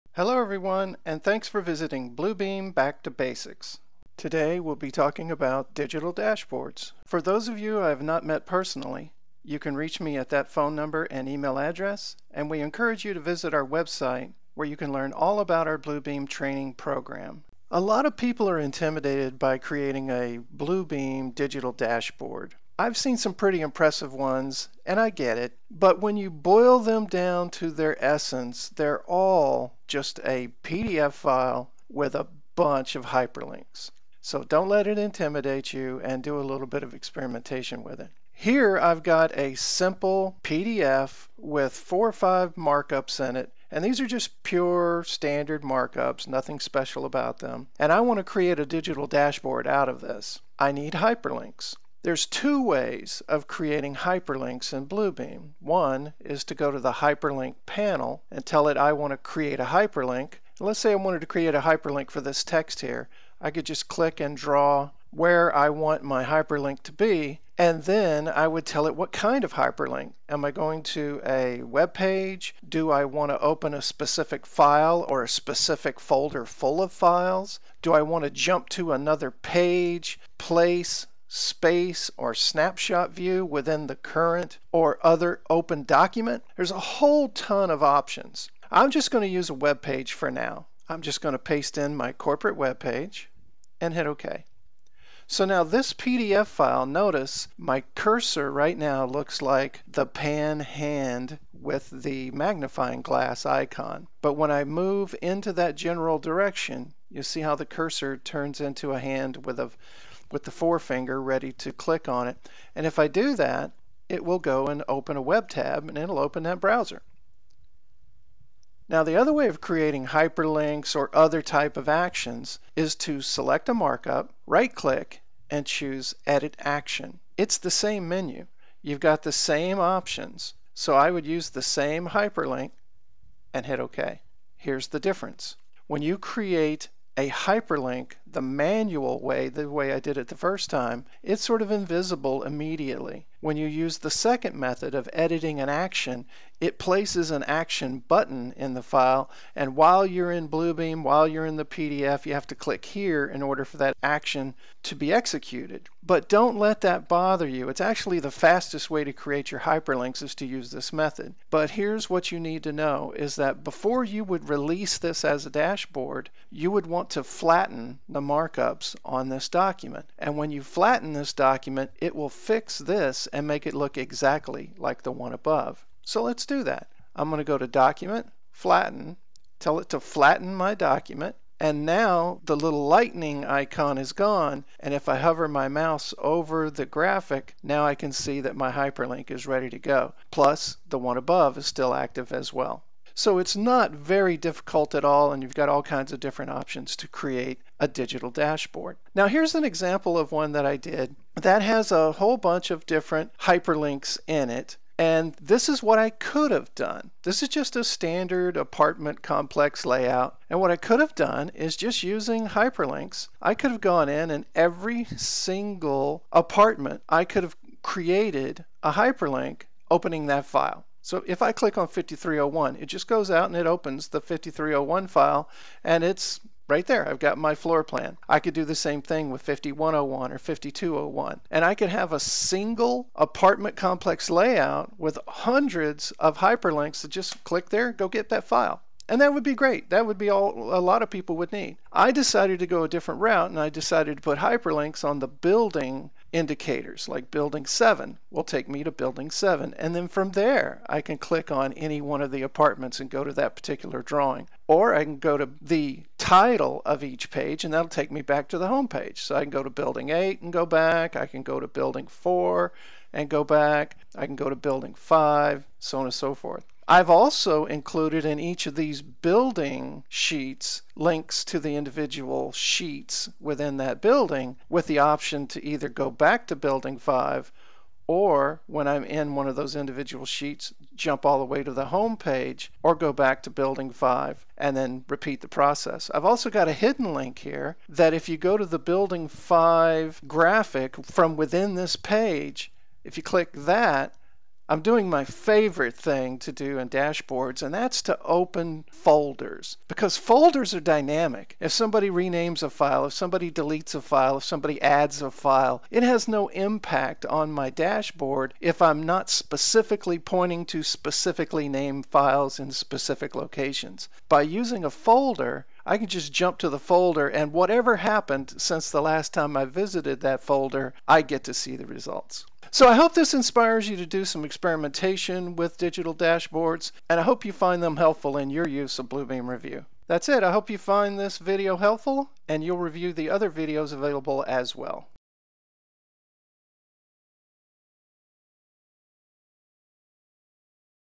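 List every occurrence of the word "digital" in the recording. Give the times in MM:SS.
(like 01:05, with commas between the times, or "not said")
00:05, 00:21, 00:48, 03:17, 05:25.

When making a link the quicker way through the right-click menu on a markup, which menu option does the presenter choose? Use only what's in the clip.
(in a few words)
Edit action.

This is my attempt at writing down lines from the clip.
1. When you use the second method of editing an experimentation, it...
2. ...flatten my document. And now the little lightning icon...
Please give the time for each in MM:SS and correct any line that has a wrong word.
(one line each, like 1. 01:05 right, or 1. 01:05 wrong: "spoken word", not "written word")
1. 02:23 wrong: "action", not "experimentation"
2. 03:00 right.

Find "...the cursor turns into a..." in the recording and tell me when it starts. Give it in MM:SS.
01:47.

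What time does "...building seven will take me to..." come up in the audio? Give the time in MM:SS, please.
04:07.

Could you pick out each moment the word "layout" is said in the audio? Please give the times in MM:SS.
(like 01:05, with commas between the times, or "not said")
03:29, 03:54.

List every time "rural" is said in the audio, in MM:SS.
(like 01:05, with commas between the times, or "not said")
not said.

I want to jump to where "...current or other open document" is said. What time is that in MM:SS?
01:23.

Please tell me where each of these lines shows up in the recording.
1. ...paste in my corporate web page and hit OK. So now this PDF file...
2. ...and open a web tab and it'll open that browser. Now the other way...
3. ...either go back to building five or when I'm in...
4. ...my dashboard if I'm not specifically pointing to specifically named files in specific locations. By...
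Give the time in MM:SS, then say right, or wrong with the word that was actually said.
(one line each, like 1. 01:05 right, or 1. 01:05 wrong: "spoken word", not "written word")
1. 01:31 right
2. 01:54 right
3. 04:35 right
4. 05:07 right.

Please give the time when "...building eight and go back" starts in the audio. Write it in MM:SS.
04:19.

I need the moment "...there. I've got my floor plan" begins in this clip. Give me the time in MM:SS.
03:46.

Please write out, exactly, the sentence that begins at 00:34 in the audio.
So don't let it intimidate you and do a little bit of experimentation with it.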